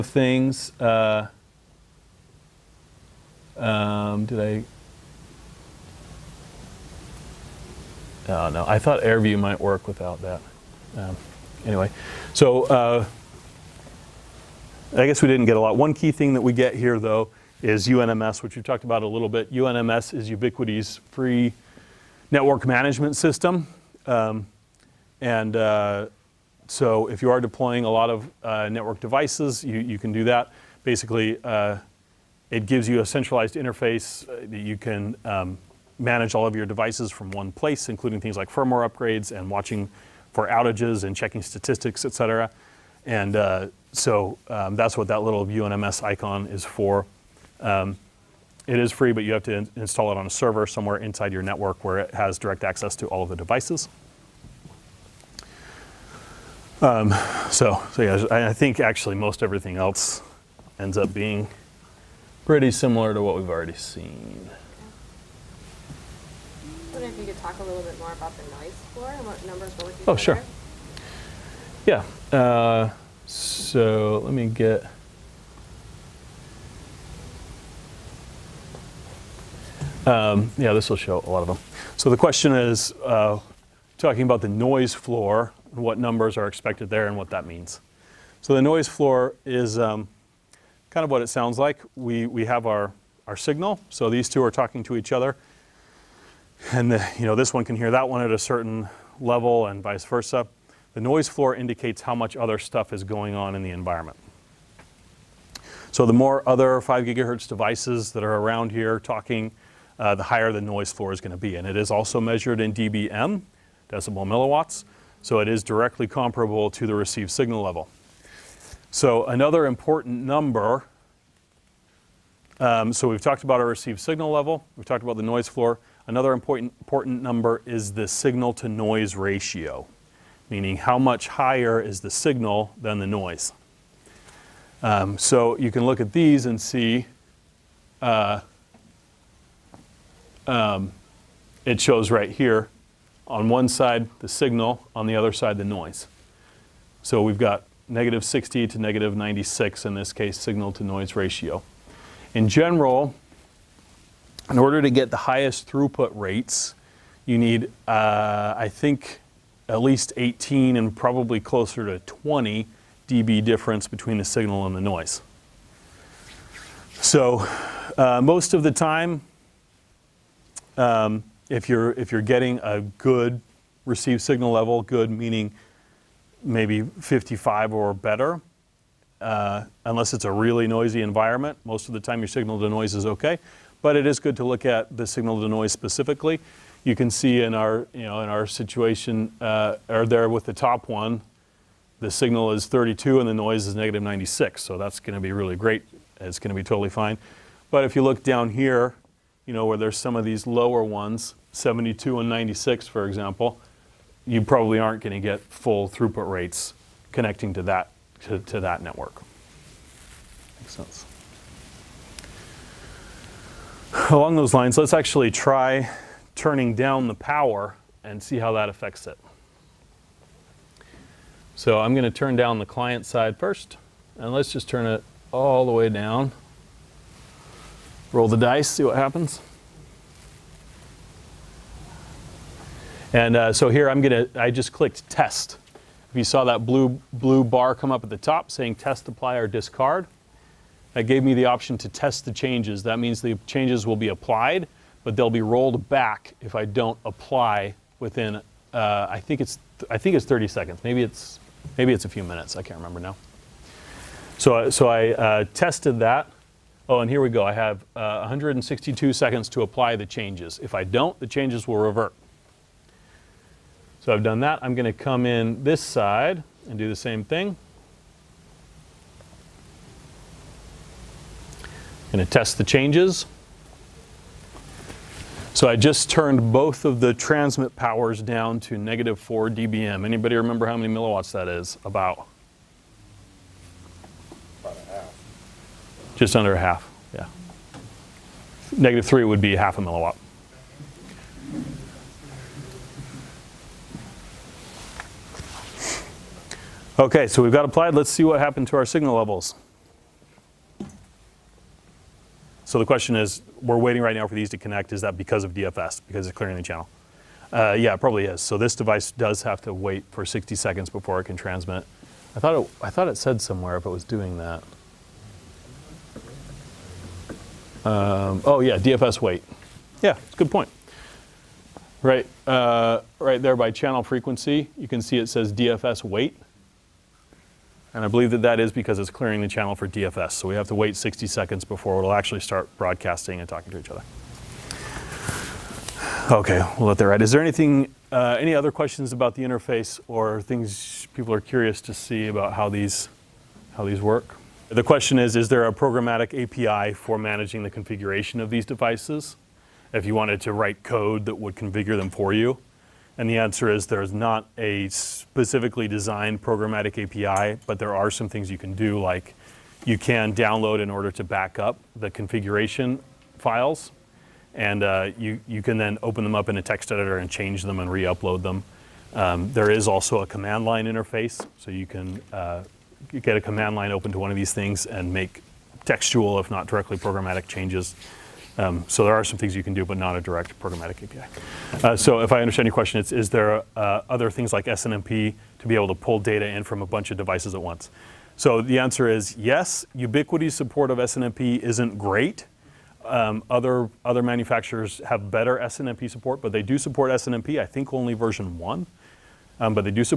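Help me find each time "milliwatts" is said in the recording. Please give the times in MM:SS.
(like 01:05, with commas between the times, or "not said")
01:54, 04:40, 04:49.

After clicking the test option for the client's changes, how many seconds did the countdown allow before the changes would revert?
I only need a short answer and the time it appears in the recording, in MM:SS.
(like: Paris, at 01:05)
162, at 04:18.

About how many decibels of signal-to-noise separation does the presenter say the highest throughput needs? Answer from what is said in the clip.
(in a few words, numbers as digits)
20 dB.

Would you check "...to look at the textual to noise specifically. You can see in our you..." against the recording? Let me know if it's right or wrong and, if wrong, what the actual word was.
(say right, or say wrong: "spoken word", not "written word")
wrong: "signal", not "textual".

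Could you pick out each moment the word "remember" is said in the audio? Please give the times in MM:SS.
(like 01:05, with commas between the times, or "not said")
04:12, 04:40.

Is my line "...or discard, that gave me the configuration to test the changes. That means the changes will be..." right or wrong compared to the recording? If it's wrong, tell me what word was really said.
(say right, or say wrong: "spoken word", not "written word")
wrong: "option", not "configuration".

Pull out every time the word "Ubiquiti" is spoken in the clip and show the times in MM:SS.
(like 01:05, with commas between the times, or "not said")
00:20, 06:29.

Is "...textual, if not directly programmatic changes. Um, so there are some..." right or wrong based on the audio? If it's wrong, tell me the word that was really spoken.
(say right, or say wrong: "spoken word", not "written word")
right.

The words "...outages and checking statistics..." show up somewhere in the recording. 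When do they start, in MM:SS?
00:40.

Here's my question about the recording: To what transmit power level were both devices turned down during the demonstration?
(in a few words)
-4 dBm.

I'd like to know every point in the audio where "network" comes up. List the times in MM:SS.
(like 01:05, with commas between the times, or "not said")
00:22, 00:28, 00:51, 03:28.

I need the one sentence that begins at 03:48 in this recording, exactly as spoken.
Roll the dice, see what happens.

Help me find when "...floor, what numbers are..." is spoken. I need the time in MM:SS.
01:24.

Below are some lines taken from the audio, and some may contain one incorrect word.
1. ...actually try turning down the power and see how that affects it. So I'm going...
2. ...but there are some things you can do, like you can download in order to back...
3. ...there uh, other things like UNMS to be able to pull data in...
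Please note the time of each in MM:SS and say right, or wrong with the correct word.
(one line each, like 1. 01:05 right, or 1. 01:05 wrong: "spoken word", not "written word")
1. 03:34 right
2. 05:57 right
3. 06:23 wrong: "SNMP", not "UNMS".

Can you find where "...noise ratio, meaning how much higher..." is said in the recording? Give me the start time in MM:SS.
02:08.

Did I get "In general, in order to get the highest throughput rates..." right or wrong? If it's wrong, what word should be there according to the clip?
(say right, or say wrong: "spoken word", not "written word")
right.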